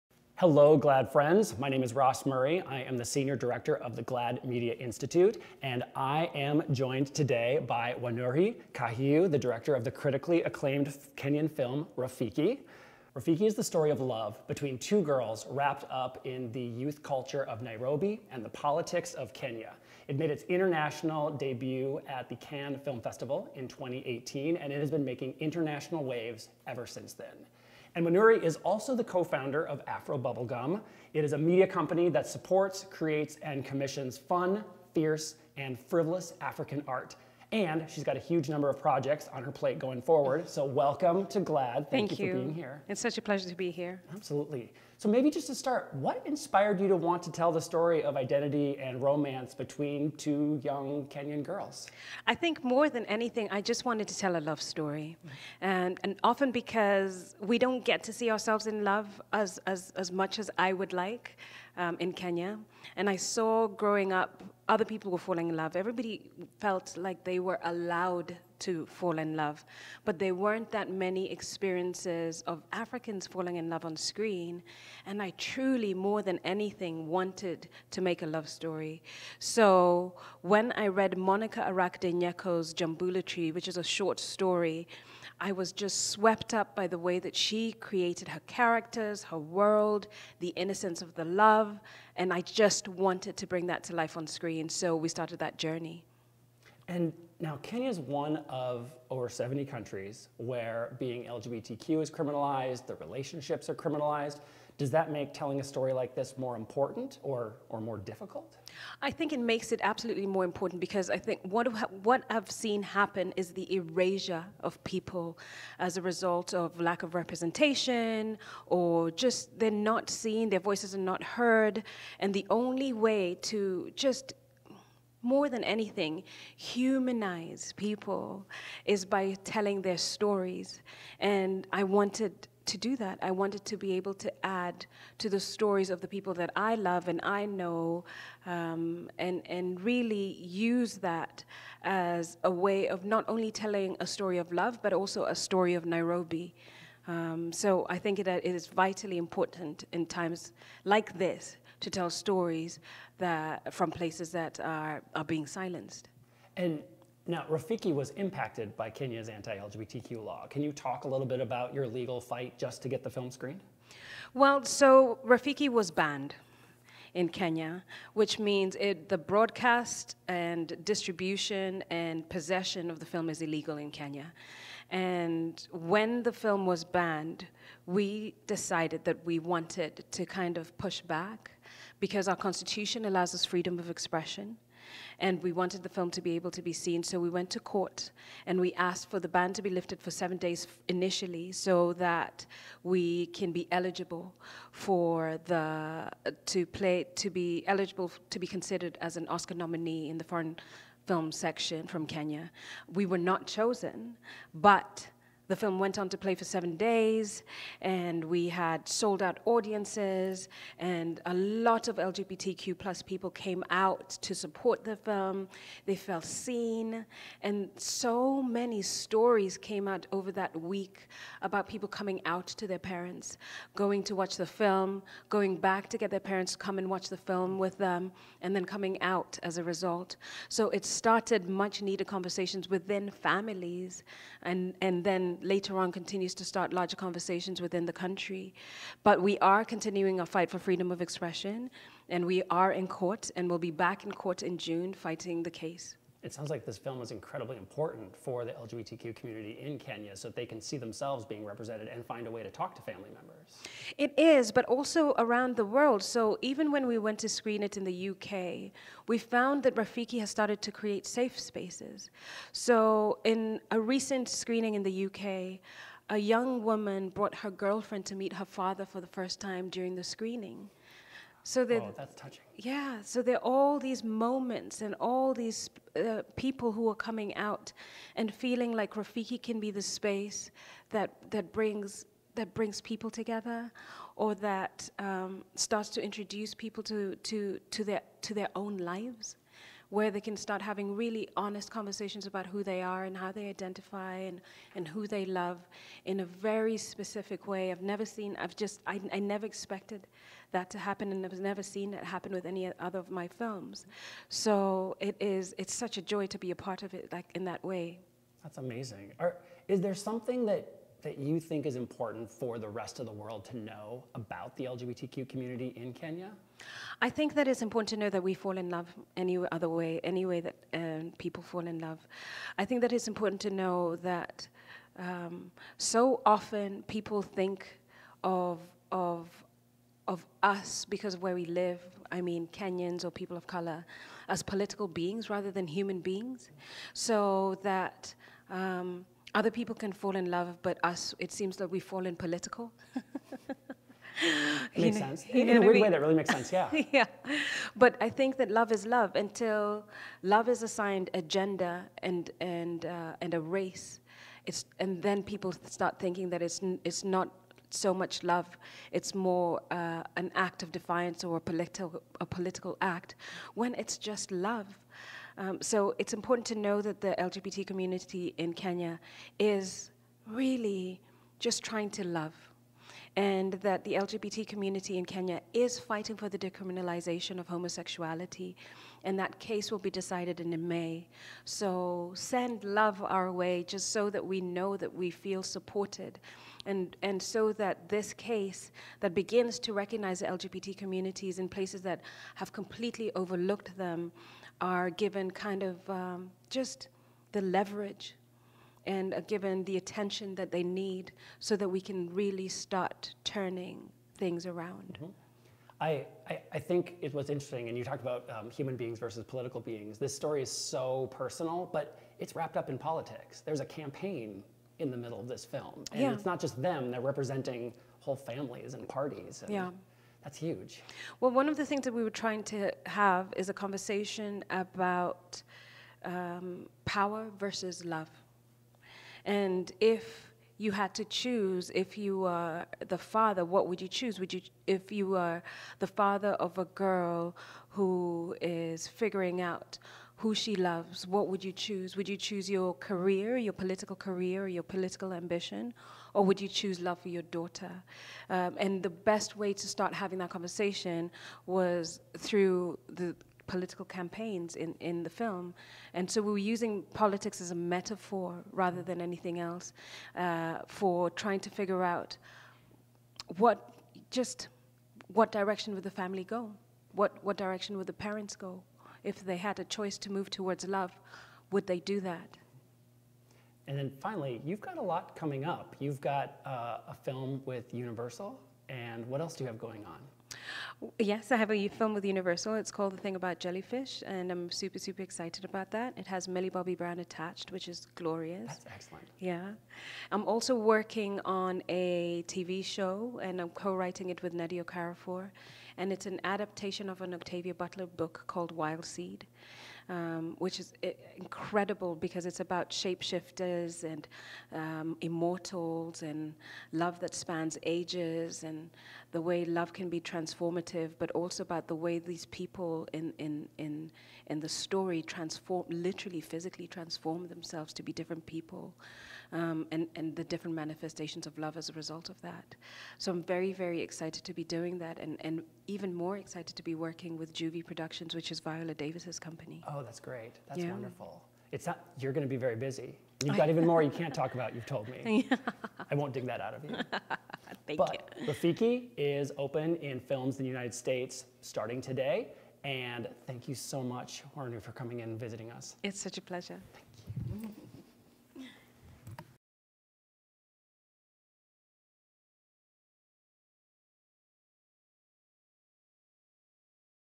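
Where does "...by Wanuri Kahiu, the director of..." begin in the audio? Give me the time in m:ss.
0:07.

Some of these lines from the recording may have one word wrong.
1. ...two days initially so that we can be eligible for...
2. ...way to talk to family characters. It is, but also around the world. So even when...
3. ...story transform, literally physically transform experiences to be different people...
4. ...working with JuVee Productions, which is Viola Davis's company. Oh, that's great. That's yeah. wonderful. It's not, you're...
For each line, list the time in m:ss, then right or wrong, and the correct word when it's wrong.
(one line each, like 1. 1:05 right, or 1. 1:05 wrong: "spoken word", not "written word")
1. 3:10 wrong: "seven", not "two"
2. 4:12 wrong: "members", not "characters"
3. 8:34 wrong: "themselves", not "experiences"
4. 8:46 right.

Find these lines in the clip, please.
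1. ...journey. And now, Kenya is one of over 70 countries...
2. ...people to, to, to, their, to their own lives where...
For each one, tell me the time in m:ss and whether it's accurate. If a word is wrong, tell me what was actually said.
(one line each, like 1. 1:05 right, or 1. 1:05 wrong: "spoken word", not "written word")
1. 1:35 right
2. 4:46 right.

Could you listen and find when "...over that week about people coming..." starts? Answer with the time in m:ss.
3:40.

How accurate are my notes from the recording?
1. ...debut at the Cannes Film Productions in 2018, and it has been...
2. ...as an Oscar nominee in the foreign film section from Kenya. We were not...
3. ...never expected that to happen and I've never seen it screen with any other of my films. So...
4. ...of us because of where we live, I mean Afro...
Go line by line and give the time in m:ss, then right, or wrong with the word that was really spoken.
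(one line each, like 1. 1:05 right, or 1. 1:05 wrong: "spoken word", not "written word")
1. 0:21 wrong: "Festival", not "Productions"
2. 3:18 right
3. 4:59 wrong: "happen", not "screen"
4. 5:30 wrong: "Kenyans", not "Afro".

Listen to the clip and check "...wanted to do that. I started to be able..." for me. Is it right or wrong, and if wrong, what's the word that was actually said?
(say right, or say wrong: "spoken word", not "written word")
wrong: "wanted", not "started".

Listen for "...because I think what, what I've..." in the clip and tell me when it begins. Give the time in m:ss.
1:50.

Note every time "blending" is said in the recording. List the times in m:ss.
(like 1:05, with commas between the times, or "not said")
not said.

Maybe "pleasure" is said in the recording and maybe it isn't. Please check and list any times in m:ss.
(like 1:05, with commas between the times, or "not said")
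0:43, 9:06.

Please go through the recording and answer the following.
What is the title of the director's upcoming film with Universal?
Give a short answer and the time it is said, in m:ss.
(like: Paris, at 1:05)
The Thing About Jellyfish, at 8:02.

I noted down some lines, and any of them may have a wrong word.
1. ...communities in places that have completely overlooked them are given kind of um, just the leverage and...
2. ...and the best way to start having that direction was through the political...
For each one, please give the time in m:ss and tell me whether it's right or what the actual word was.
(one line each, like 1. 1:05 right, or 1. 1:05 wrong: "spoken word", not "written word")
1. 6:30 right
2. 7:28 wrong: "conversation", not "direction".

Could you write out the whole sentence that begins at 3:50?
So it started much needed conversations within families and, and then later on continues to start larger conversations within the country.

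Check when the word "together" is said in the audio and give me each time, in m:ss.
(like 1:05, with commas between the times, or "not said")
4:43.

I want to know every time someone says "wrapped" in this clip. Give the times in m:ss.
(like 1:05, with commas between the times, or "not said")
0:15, 6:52.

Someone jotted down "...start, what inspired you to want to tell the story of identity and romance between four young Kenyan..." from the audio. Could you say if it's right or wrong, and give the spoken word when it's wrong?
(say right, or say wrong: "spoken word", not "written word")
wrong: "two", not "four".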